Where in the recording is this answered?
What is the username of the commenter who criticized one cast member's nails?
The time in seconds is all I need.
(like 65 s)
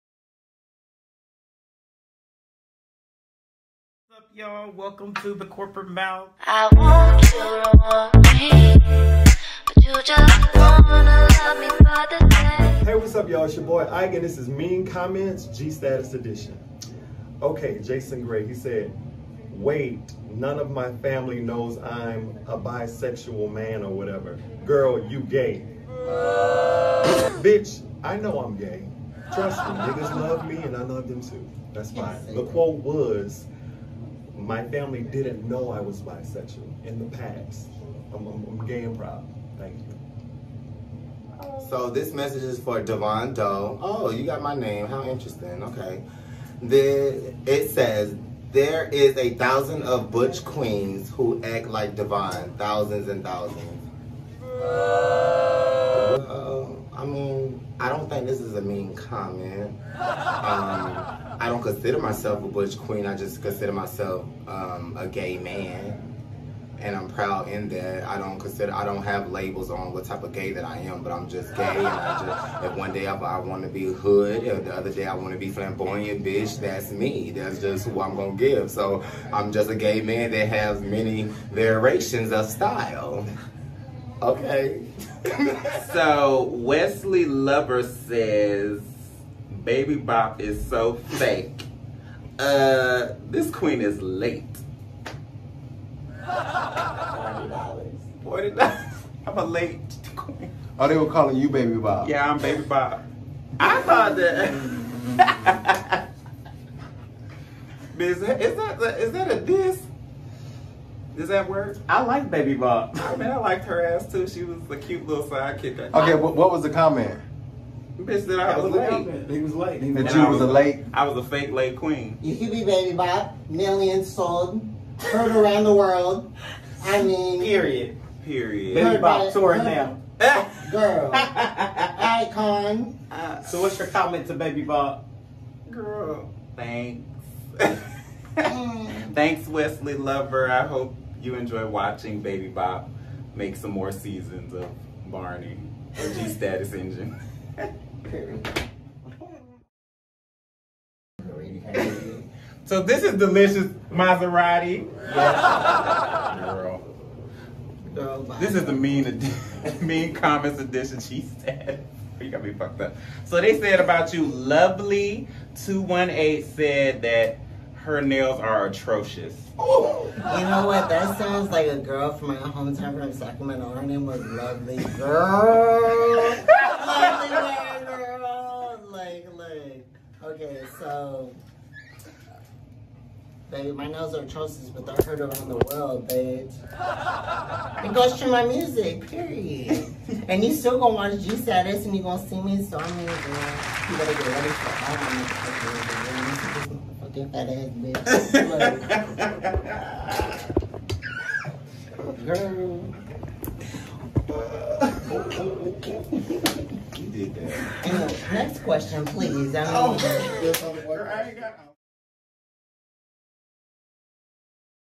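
164 s.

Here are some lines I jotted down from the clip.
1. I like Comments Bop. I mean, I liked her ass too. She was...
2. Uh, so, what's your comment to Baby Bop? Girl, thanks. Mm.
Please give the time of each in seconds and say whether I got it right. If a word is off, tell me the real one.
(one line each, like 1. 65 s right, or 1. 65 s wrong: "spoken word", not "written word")
1. 111 s wrong: "Baby", not "Comments"
2. 133 s right.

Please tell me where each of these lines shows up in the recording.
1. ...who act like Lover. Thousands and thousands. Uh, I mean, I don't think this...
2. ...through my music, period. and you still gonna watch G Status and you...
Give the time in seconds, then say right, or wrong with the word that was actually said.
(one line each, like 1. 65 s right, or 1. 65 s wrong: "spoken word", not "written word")
1. 51 s wrong: "Devon", not "Lover"
2. 188 s right.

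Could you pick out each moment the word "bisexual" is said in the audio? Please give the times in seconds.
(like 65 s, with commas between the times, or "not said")
22 s, 36 s.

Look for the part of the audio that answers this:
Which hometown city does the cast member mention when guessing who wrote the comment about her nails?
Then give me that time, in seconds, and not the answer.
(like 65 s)
173 s.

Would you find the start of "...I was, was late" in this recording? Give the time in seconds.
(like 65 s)
118 s.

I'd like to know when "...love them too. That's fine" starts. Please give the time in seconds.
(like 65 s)
30 s.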